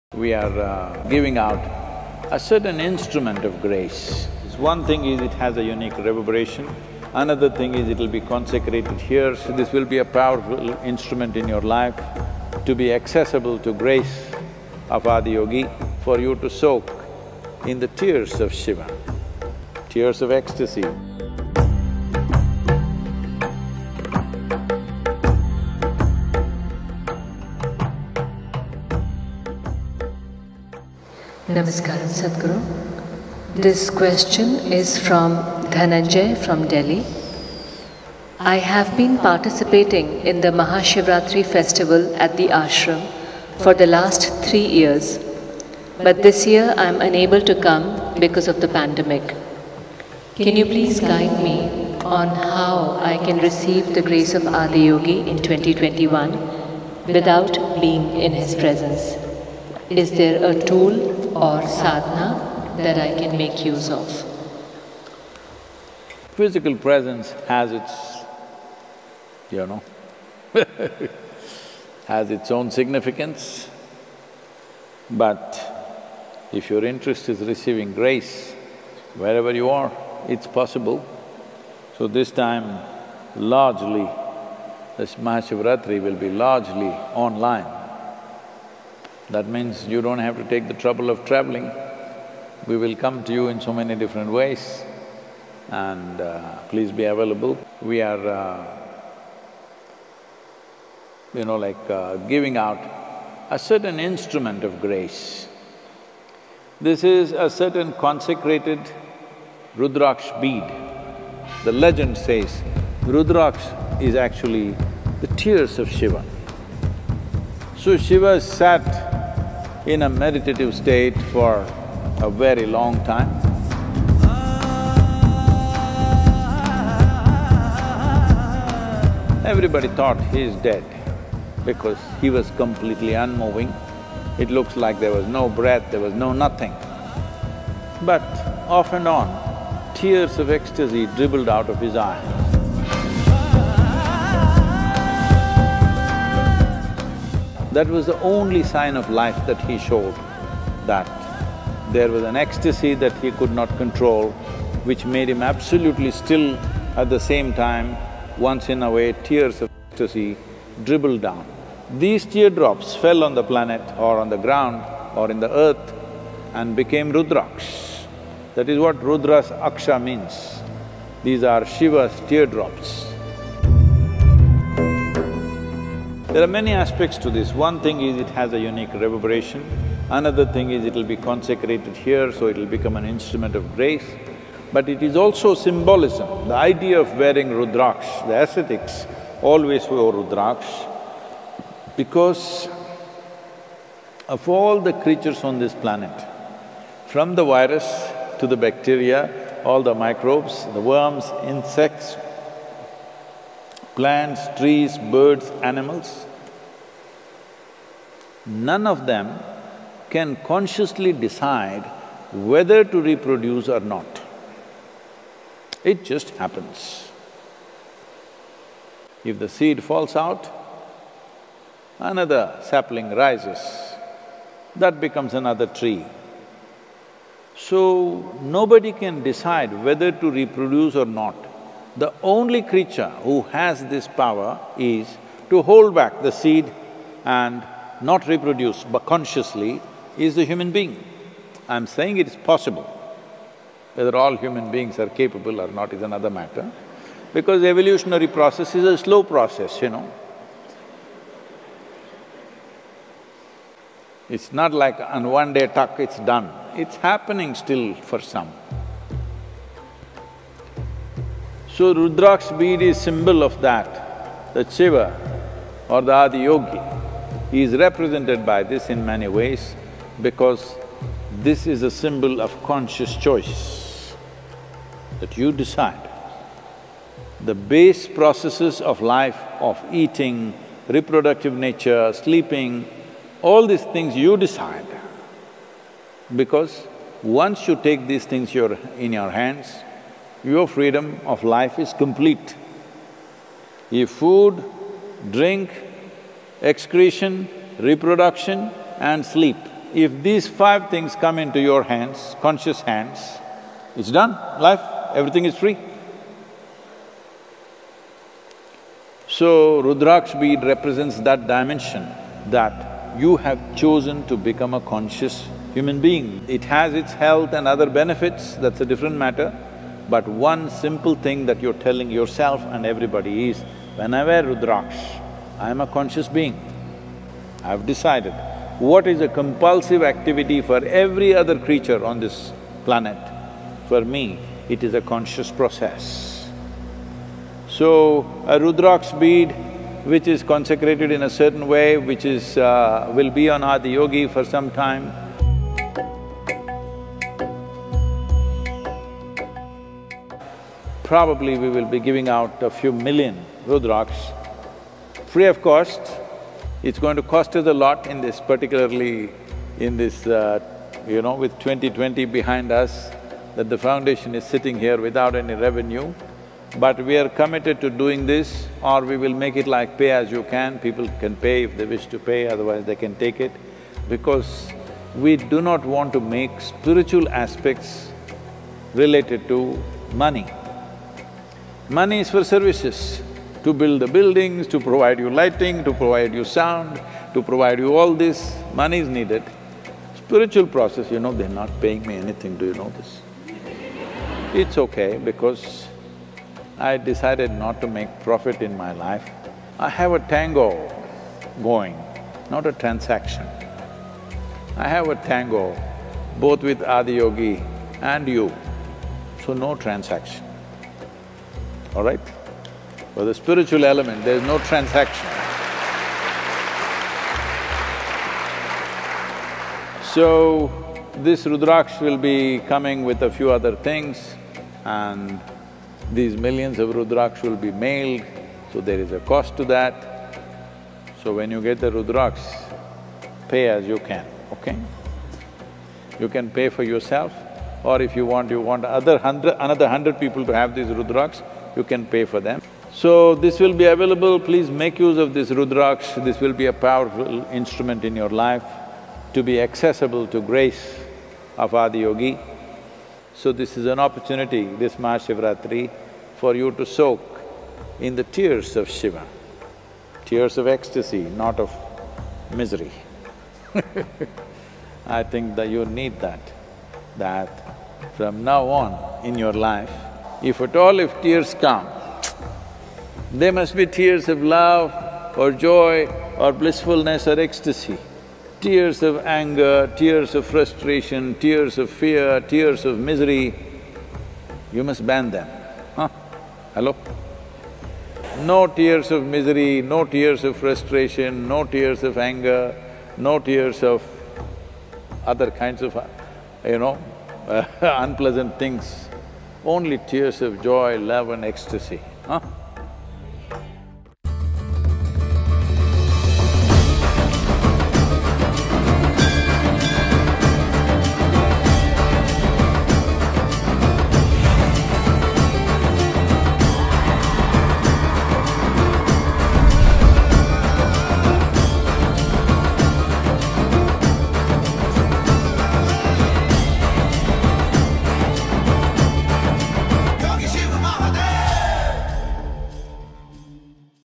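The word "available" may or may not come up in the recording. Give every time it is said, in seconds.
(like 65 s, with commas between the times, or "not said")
97 s, 443 s.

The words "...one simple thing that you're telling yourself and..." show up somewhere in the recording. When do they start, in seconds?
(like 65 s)
320 s.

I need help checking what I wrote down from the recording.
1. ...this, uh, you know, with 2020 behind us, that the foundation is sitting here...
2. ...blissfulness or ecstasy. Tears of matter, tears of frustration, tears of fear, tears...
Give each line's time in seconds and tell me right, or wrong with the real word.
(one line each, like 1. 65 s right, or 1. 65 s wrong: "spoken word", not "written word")
1. 359 s right
2. 476 s wrong: "anger", not "matter".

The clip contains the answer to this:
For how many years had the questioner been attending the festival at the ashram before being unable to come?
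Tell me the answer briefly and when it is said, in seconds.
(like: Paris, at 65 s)
3, at 44 s.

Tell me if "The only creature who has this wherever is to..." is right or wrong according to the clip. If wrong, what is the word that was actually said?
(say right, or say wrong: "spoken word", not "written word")
wrong: "power", not "wherever".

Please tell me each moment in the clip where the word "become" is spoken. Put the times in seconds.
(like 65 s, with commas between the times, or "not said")
182 s, 224 s, 314 s.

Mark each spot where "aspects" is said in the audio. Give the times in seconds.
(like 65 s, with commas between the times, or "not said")
176 s, 377 s.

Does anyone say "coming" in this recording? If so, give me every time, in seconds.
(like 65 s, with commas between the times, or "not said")
422 s.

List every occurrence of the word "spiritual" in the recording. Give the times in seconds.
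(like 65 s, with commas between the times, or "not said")
376 s, 390 s, 413 s.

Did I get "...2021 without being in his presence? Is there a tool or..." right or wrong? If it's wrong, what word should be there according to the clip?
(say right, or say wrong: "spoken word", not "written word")
right.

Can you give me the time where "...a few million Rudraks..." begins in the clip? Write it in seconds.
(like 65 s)
352 s.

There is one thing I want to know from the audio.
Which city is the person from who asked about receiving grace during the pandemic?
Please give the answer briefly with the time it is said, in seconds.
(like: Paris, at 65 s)
Delhi, at 36 s.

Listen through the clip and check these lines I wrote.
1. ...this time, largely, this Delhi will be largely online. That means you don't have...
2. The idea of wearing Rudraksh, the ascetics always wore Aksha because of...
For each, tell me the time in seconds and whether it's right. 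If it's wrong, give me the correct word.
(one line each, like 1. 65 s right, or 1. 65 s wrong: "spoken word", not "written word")
1. 82 s wrong: "Mahashivratri", not "Delhi"
2. 186 s wrong: "Rudraksh", not "Aksha".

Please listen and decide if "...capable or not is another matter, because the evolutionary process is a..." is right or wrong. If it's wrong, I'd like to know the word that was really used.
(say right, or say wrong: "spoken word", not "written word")
right.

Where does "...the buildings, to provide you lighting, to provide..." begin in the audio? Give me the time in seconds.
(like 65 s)
384 s.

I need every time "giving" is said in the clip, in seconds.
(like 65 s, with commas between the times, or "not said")
1 s, 102 s, 351 s.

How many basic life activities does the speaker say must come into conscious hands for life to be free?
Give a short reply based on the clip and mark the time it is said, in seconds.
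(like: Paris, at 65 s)
5, at 300 s.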